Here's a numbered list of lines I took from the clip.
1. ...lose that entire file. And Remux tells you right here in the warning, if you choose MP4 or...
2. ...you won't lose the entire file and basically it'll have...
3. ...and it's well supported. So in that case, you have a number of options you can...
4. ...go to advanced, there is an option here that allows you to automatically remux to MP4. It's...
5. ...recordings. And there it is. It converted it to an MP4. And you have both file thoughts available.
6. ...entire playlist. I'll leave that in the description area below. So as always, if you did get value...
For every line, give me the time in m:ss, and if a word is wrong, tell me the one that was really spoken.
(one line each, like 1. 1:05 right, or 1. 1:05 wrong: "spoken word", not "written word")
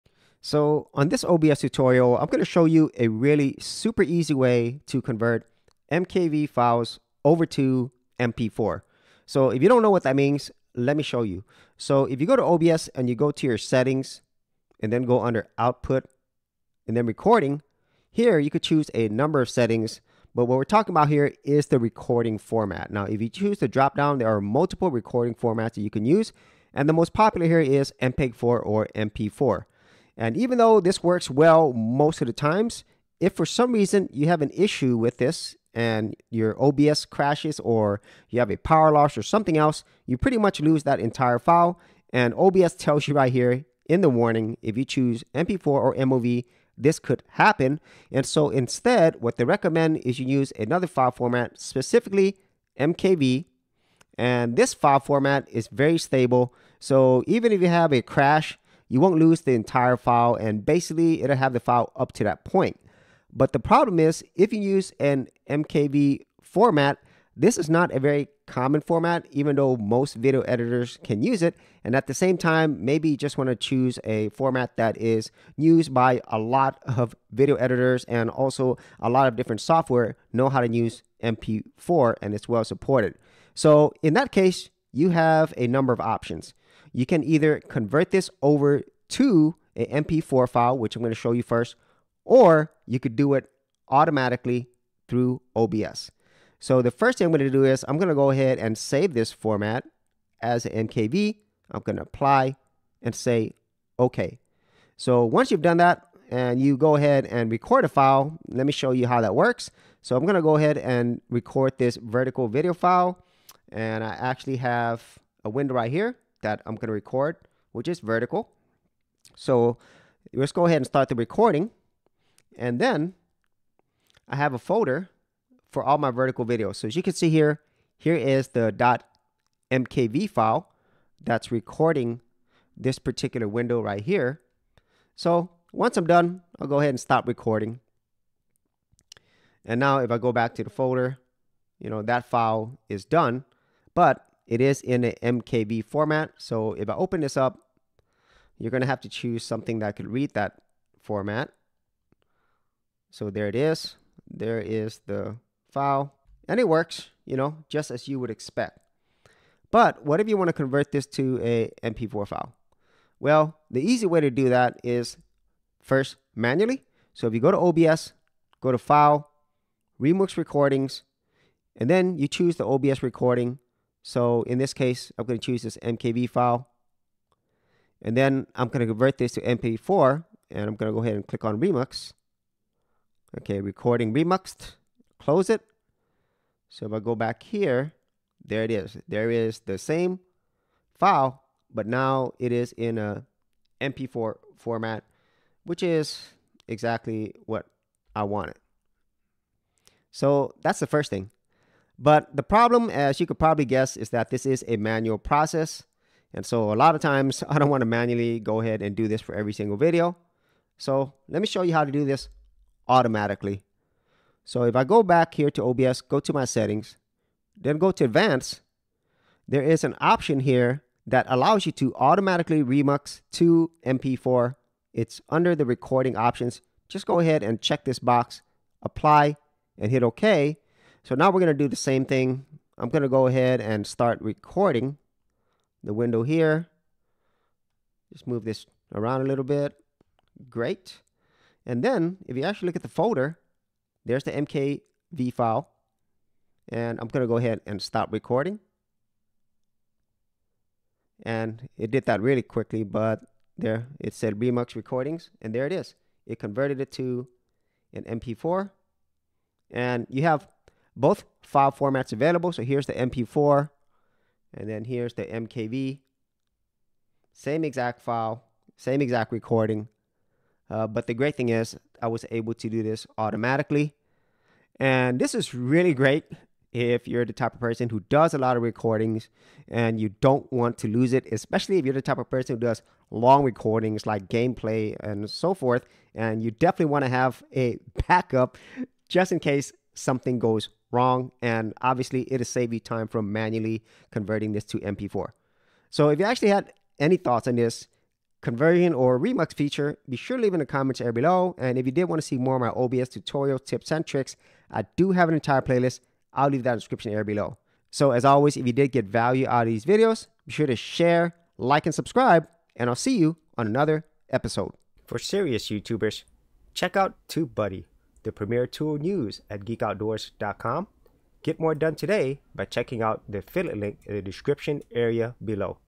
1. 0:40 wrong: "OBS", not "Remux"
2. 0:58 right
3. 1:22 right
4. 3:37 right
5. 4:14 wrong: "formats", not "thoughts"
6. 5:05 right.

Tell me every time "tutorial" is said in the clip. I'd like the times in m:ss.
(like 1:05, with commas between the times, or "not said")
0:01, 5:03.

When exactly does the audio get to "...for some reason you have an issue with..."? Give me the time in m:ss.
0:33.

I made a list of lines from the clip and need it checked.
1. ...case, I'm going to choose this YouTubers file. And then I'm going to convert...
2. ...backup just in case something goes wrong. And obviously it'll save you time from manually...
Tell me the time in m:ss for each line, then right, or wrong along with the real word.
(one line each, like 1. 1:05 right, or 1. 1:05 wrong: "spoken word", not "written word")
1. 2:54 wrong: "MKV", not "YouTubers"
2. 4:48 right.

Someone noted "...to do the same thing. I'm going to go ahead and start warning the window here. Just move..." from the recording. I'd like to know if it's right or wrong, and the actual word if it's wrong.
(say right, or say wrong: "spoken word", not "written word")
wrong: "recording", not "warning".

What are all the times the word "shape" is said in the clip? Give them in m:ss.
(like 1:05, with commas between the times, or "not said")
not said.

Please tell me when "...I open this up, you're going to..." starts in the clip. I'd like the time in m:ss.
2:26.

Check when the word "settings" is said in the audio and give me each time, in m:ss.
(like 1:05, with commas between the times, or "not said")
0:13, 0:19, 3:36.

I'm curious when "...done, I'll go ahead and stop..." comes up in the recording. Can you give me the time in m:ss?
2:16.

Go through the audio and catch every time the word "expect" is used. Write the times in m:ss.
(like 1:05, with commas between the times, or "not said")
2:38.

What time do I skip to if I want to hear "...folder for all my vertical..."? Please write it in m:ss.
2:04.